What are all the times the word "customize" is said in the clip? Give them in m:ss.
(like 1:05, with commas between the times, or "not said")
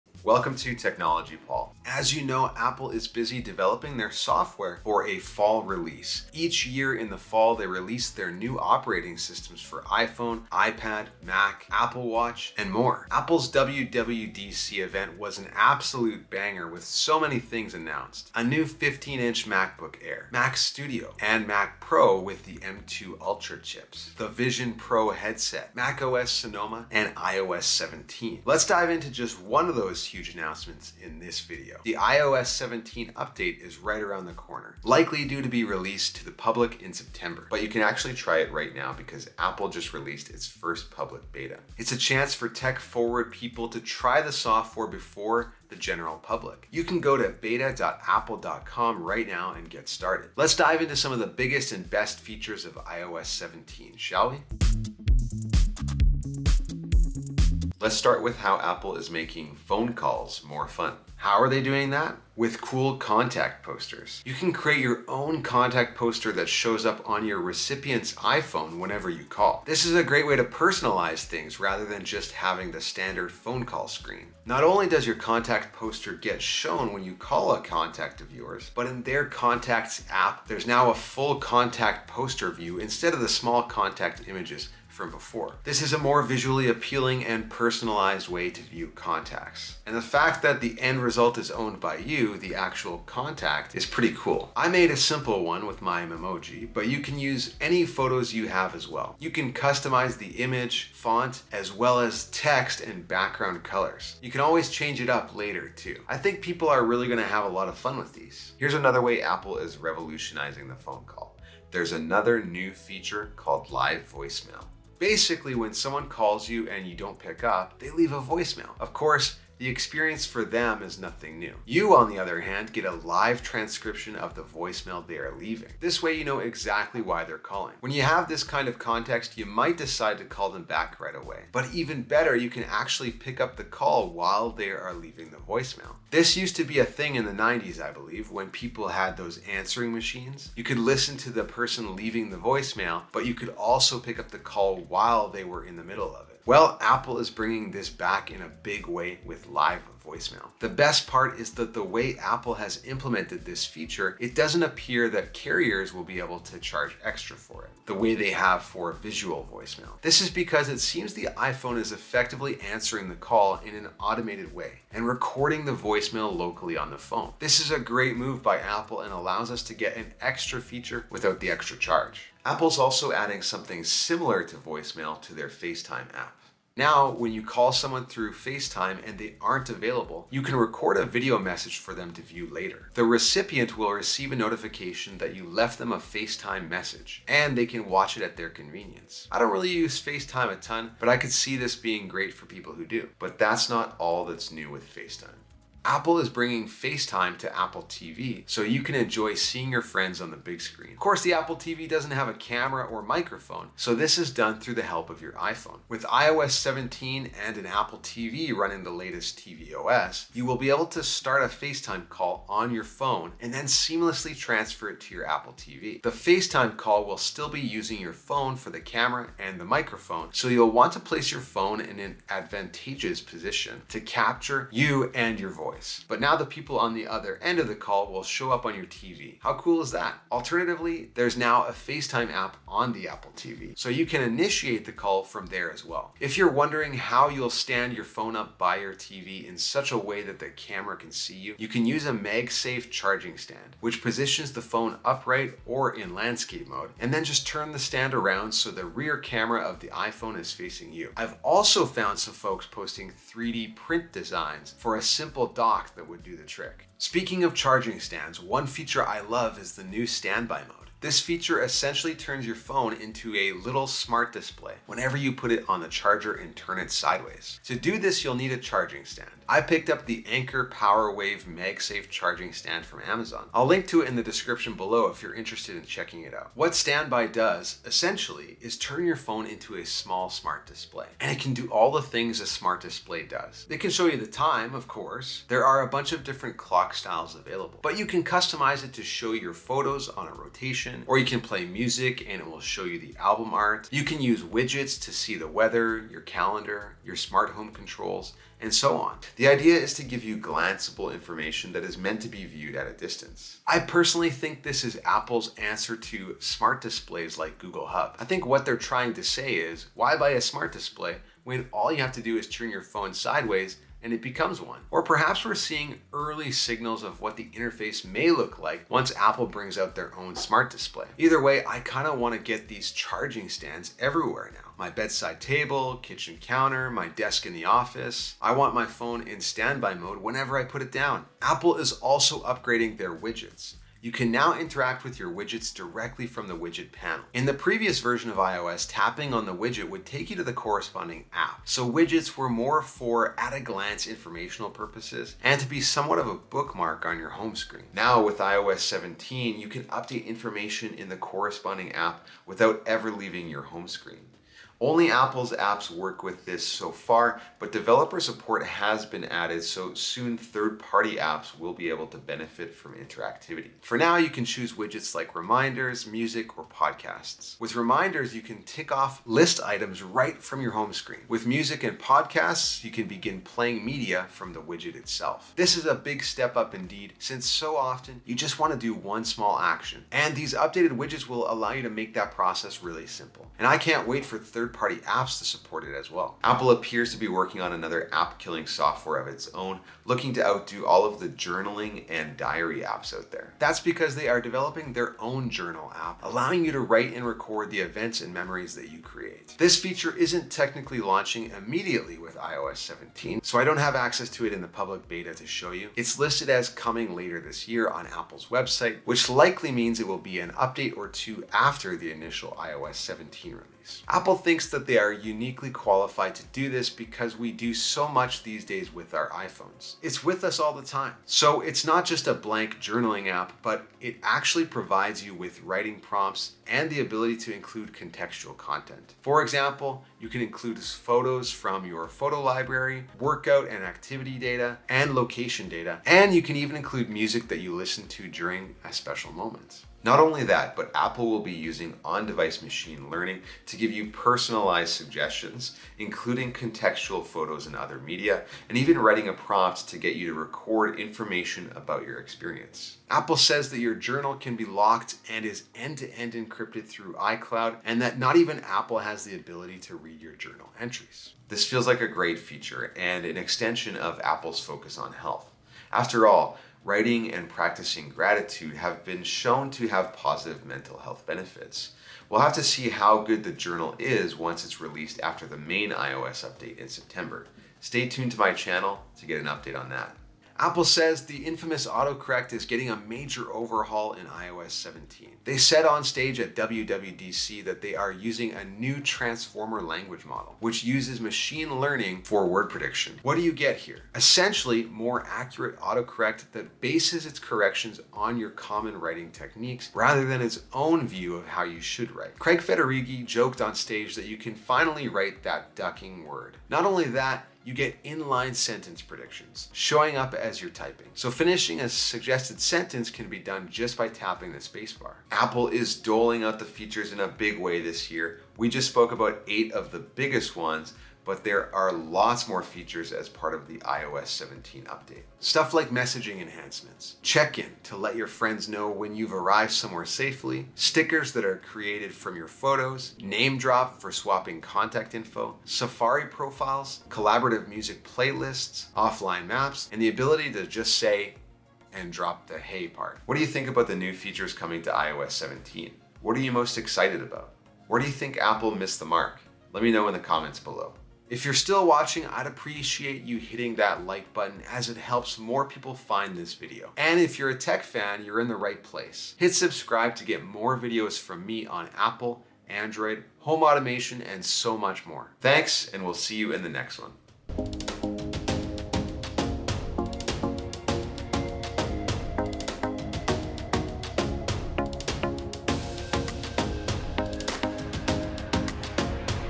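1:39, 4:48.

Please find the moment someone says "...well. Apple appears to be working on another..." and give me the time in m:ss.
6:26.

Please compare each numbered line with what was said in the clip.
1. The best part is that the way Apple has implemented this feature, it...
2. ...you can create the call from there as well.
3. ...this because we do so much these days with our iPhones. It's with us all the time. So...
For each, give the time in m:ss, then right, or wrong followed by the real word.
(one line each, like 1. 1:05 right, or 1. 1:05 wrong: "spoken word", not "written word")
1. 2:30 right
2. 3:53 wrong: "initiate", not "create"
3. 6:56 right.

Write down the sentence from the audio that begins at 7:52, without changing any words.
We'll have to see how good the journal is once it's released after the main iOS update in September.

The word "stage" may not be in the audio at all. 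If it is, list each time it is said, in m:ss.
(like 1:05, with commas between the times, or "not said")
8:06, 8:23.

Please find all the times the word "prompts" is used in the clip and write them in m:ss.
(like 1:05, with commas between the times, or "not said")
7:05, 7:29.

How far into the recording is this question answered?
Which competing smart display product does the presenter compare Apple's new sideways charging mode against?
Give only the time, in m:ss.
5:07.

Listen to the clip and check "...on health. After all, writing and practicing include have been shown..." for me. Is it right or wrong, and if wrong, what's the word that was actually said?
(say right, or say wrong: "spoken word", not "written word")
wrong: "gratitude", not "include".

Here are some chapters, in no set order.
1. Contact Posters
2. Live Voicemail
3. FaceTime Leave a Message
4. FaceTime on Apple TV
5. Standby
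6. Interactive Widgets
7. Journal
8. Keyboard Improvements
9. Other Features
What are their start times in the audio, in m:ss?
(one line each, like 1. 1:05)
1. 1:00
2. 1:49
3. 2:53
4. 3:14
5. 4:17
6. 5:32
7. 6:27
8. 8:00
9. 8:46.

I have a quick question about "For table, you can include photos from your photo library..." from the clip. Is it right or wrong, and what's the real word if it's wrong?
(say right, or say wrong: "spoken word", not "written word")
wrong: "example", not "table".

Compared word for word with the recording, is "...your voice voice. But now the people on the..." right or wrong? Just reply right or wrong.
right.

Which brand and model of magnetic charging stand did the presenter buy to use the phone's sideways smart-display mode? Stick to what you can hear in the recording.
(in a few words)
Anker PowerWave MagSafe.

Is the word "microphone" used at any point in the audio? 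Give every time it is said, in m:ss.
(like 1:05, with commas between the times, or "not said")
3:23, 3:39.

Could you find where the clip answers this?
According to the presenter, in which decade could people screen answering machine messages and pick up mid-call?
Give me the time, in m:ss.
2:17.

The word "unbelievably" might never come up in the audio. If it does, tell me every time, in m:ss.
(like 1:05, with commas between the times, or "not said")
not said.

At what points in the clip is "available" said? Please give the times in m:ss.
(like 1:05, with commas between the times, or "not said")
2:59, 4:47.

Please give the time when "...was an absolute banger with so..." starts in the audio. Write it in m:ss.
0:15.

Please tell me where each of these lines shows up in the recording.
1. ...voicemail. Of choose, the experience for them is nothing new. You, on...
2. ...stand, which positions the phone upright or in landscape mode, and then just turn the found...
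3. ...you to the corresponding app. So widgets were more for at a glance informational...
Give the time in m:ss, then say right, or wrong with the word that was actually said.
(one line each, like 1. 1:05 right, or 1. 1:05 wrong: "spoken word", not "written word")
1. 1:58 wrong: "course", not "choose"
2. 4:03 wrong: "stand", not "found"
3. 5:40 right.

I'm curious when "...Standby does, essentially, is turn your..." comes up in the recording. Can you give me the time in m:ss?
4:36.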